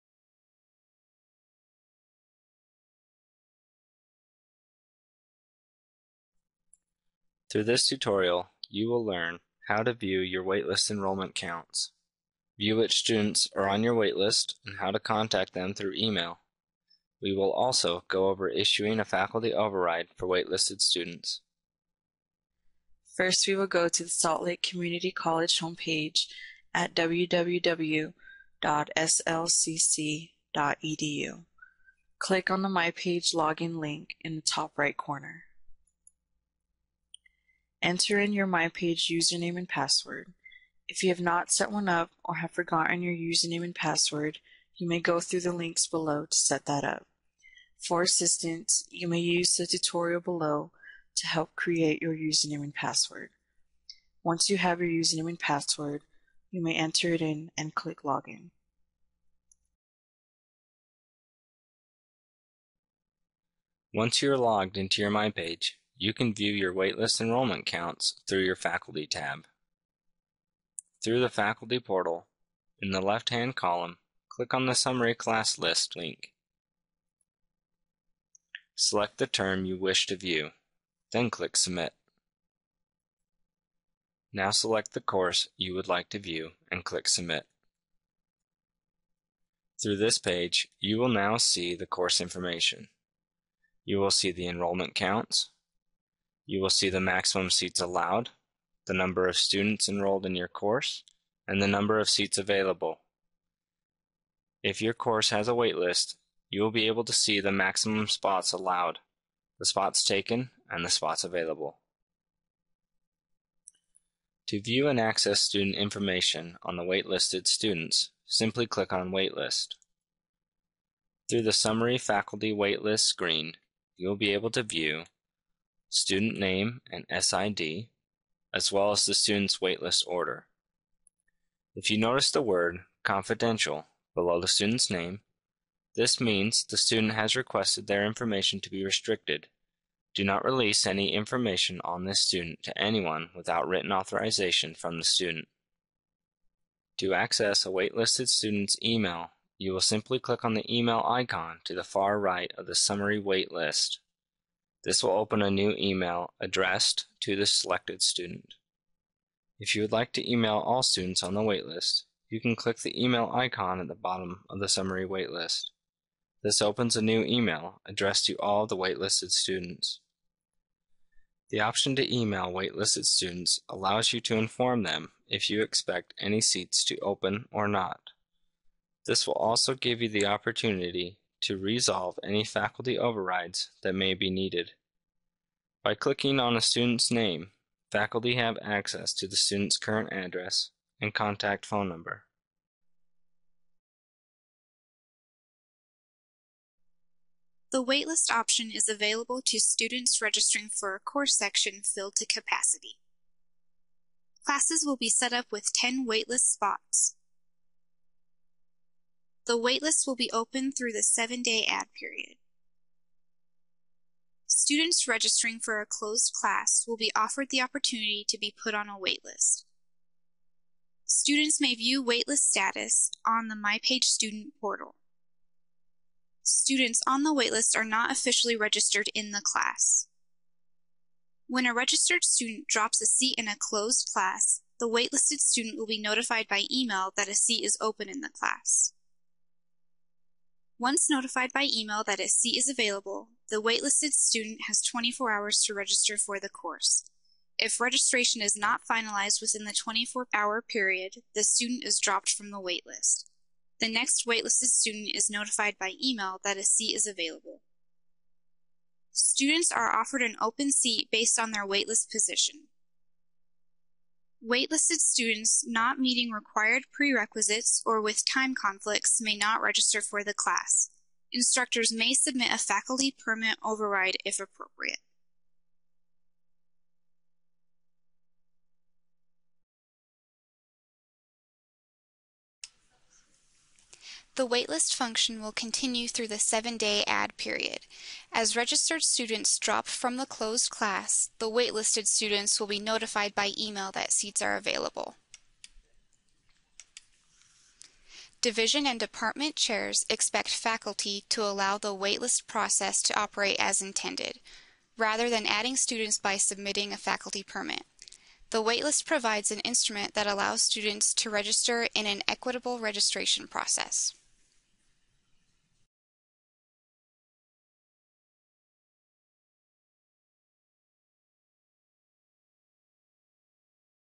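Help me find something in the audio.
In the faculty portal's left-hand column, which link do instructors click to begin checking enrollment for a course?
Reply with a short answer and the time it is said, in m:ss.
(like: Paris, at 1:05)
Summary Class List, at 1:14.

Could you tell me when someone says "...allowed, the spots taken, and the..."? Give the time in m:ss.
1:48.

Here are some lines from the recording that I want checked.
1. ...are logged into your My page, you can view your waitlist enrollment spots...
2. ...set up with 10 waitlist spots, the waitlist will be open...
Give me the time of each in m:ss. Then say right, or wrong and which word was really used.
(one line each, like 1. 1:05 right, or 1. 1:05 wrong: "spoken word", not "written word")
1. 1:04 wrong: "counts", not "spots"
2. 3:25 right.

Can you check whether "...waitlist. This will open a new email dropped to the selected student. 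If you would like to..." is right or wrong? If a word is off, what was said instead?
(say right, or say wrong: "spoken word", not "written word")
wrong: "addressed", not "dropped".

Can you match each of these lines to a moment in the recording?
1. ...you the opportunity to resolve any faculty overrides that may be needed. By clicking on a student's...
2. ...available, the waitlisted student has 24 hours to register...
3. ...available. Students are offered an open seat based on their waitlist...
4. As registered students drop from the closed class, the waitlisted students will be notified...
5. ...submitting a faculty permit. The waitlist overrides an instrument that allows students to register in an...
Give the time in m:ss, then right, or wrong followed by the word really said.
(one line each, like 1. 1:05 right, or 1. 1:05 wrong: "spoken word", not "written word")
1. 3:00 right
2. 4:02 right
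3. 4:17 right
4. 4:48 right
5. 5:06 wrong: "provides", not "overrides".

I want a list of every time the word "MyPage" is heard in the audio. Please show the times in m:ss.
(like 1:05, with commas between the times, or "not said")
0:38, 3:43.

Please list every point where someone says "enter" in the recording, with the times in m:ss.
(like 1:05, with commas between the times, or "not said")
0:37, 0:56.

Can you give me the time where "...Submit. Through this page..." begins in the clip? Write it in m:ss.
1:27.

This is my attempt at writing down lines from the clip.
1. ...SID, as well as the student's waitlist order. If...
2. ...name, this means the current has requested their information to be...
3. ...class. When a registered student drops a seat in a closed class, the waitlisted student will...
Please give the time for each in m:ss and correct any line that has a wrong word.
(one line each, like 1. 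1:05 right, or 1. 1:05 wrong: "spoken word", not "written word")
1. 2:07 right
2. 2:14 wrong: "student", not "current"
3. 3:49 right.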